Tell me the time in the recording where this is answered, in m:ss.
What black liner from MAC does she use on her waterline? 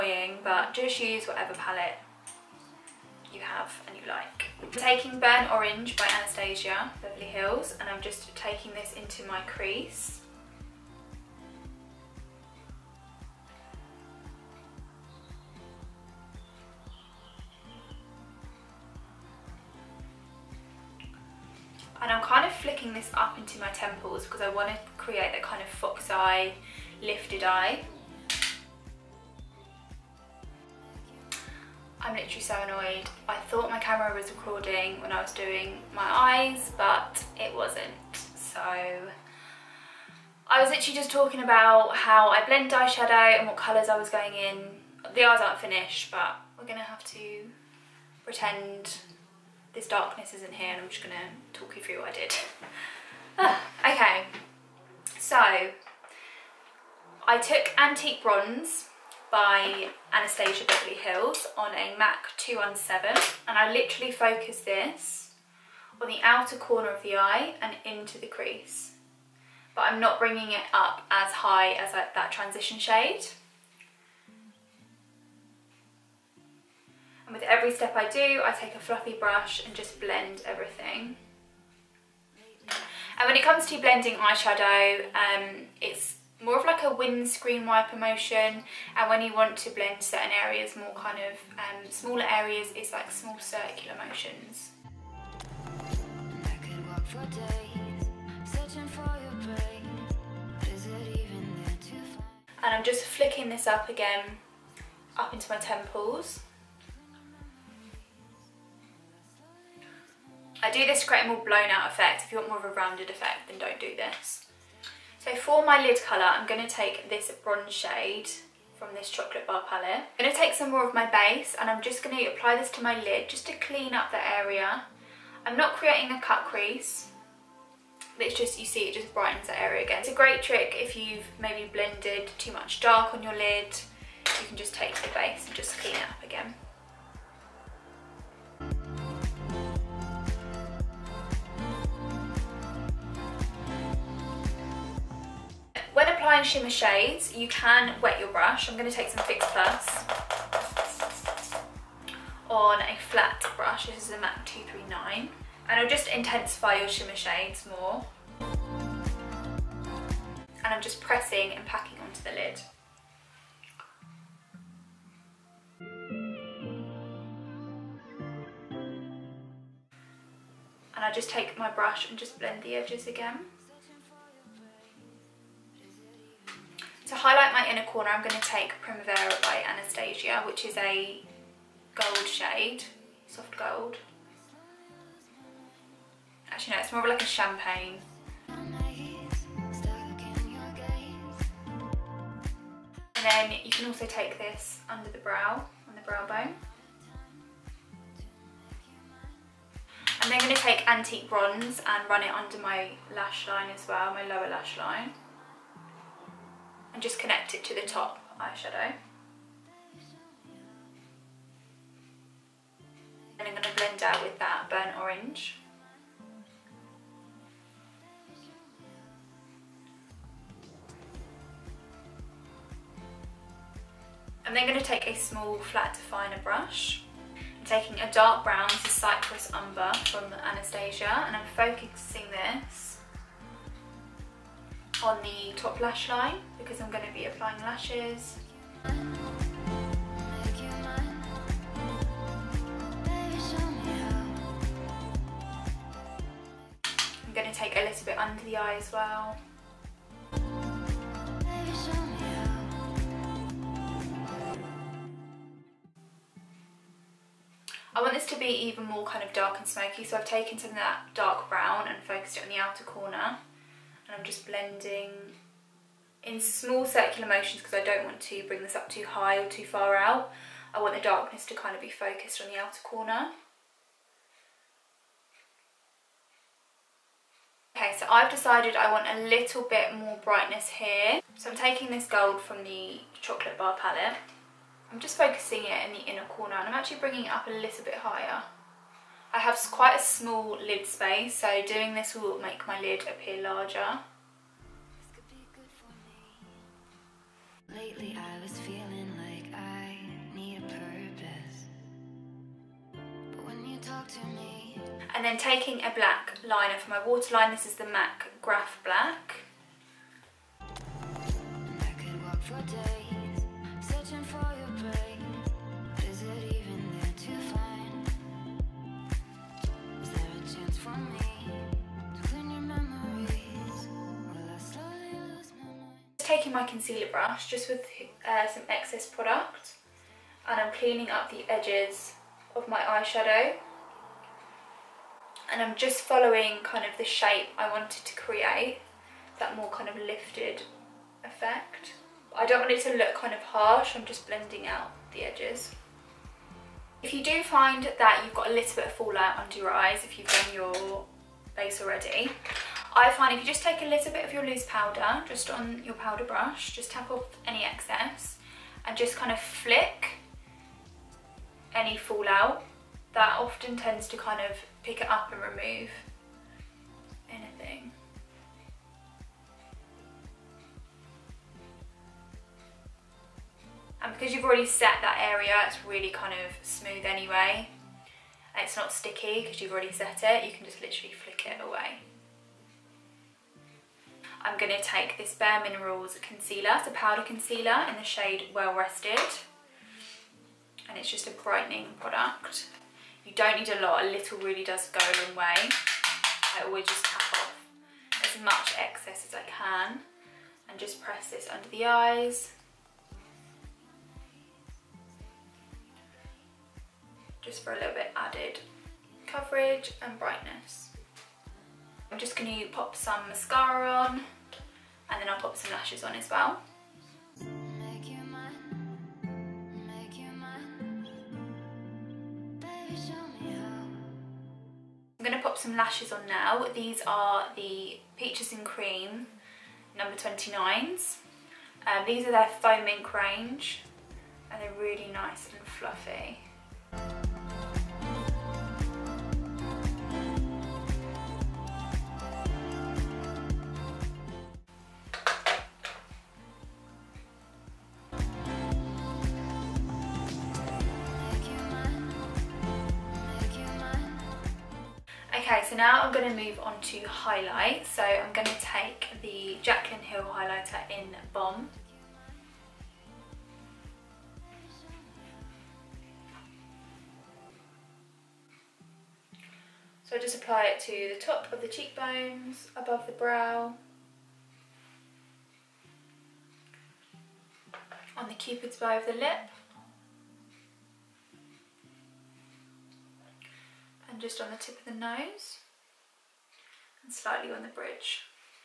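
5:08.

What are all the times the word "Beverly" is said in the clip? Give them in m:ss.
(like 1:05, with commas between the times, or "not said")
0:07, 1:00.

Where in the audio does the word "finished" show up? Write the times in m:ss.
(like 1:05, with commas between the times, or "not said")
0:45.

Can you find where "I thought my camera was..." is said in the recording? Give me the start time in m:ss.
0:33.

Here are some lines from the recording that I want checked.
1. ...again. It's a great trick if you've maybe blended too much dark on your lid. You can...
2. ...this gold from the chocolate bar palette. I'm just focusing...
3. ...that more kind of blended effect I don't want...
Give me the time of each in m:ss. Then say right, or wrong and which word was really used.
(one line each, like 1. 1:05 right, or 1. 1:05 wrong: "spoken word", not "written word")
1. 2:09 right
2. 4:41 right
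3. 5:39 wrong: "lifted", not "blended".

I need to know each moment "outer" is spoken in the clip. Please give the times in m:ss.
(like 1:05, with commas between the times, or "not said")
1:06, 4:22, 4:32.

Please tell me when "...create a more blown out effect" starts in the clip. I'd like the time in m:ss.
1:51.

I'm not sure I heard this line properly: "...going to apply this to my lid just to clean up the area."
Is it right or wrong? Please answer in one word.
right.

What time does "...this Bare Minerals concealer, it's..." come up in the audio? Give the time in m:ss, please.
6:25.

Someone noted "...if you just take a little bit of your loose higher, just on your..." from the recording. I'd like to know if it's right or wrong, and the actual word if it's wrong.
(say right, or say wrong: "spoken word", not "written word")
wrong: "powder", not "higher".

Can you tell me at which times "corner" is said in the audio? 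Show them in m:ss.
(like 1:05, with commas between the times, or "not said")
1:06, 2:57, 4:22, 4:32, 4:46.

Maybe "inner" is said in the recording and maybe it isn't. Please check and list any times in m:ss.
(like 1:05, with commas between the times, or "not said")
2:57, 4:46.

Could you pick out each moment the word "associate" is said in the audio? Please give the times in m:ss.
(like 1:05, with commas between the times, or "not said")
not said.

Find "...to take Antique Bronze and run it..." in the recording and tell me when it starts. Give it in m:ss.
3:20.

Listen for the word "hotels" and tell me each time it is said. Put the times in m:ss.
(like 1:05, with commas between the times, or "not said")
not said.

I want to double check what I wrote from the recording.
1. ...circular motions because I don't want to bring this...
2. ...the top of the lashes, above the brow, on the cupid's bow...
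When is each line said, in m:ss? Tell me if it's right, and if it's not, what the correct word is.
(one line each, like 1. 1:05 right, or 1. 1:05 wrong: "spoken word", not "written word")
1. 4:26 right
2. 7:51 wrong: "cheekbones", not "lashes".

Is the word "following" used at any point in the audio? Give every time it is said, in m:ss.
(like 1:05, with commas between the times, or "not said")
5:36.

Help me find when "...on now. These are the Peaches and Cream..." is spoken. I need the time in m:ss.
7:06.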